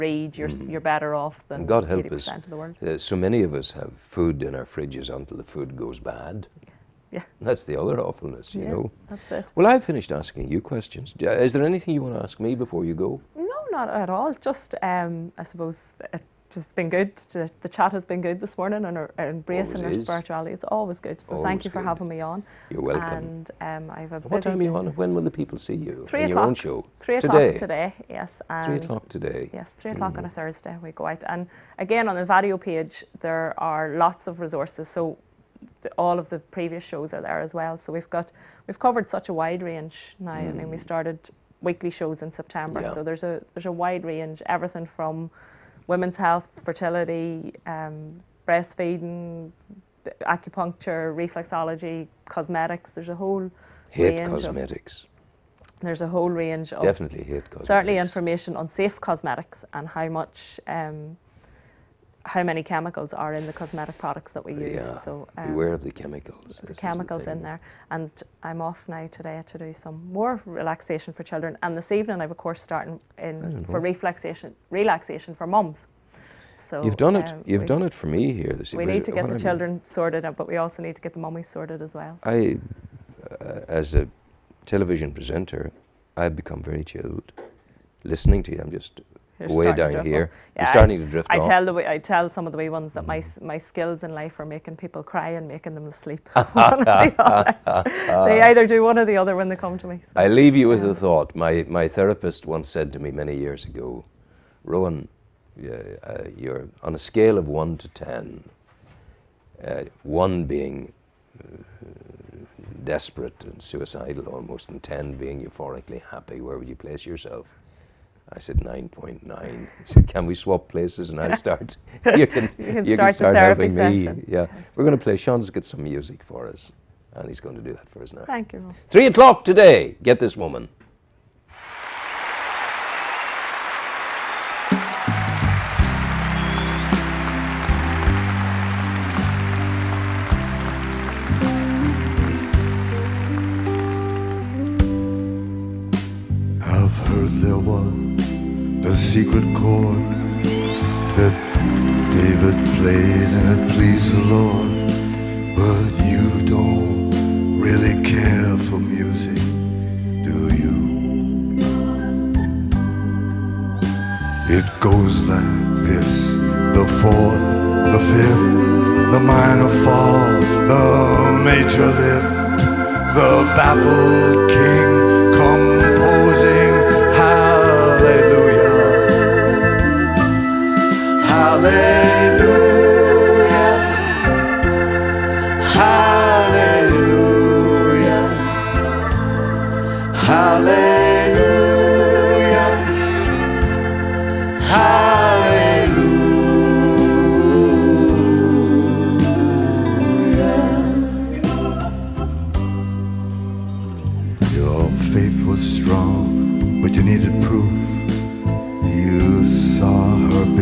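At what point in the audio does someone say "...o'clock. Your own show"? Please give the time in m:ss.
0:26.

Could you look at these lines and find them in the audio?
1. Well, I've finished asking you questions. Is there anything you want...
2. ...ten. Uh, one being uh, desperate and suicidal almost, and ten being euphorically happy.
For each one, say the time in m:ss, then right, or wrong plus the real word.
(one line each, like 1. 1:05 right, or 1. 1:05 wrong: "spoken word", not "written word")
1. 0:09 right
2. 1:47 right.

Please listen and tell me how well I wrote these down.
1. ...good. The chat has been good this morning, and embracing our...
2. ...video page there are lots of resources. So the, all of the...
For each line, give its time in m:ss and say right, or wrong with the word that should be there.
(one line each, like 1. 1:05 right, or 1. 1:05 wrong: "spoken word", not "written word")
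1. 0:16 right
2. 0:32 right.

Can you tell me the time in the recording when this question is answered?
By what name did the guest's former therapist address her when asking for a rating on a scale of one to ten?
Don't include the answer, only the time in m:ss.
1:44.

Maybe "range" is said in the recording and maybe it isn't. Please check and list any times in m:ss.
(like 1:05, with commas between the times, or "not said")
0:39, 0:44, 0:56.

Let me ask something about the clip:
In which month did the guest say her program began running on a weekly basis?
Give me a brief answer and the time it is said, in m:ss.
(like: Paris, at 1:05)
September, at 0:42.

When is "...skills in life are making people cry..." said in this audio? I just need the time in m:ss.
1:33.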